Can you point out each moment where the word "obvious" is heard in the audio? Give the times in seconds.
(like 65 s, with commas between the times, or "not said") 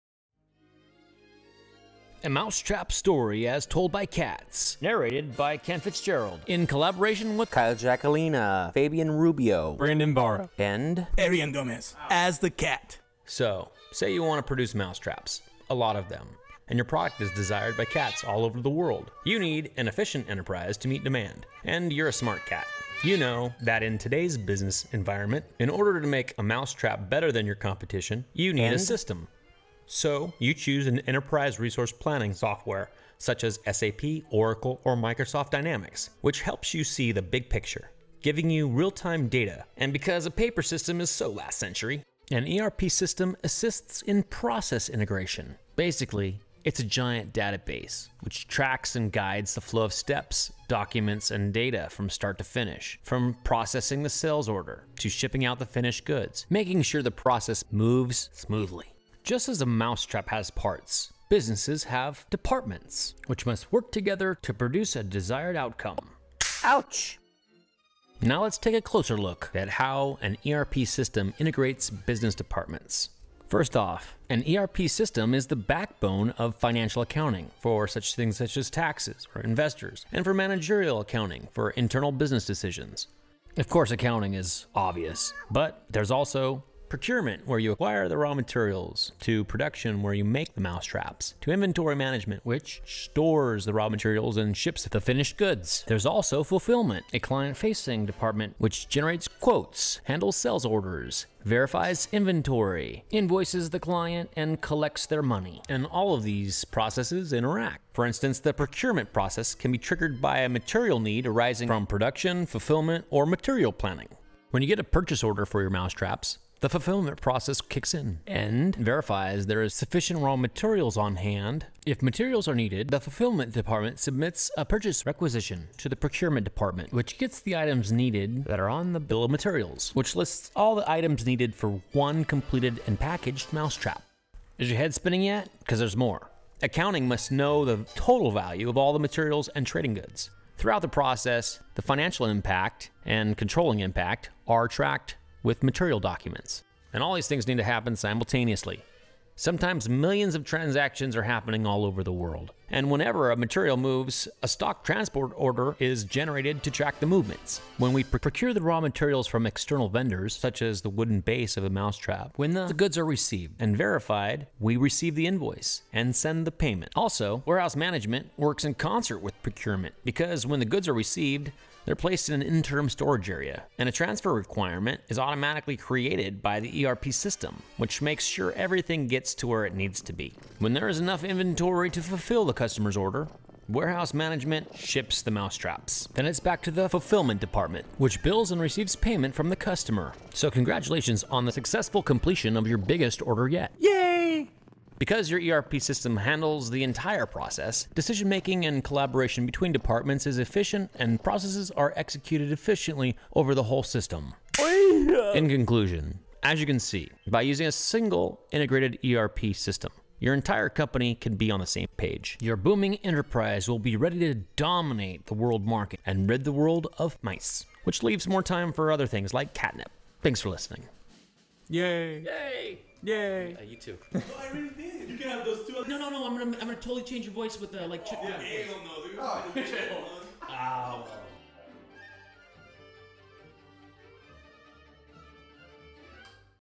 84 s.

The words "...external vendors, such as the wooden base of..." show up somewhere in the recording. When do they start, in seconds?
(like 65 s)
159 s.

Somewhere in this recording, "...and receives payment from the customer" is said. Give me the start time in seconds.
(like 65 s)
188 s.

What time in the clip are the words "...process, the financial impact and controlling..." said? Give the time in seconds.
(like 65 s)
140 s.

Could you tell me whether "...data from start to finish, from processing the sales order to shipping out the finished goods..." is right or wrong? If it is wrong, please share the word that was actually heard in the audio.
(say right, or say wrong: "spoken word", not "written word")
right.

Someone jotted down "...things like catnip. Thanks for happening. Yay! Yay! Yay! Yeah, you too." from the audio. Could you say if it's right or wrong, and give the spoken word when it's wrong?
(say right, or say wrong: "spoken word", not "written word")
wrong: "listening", not "happening".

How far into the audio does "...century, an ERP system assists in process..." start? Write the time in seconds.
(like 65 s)
41 s.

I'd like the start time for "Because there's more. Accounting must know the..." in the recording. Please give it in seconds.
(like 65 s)
135 s.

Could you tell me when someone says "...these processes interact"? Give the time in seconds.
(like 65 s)
106 s.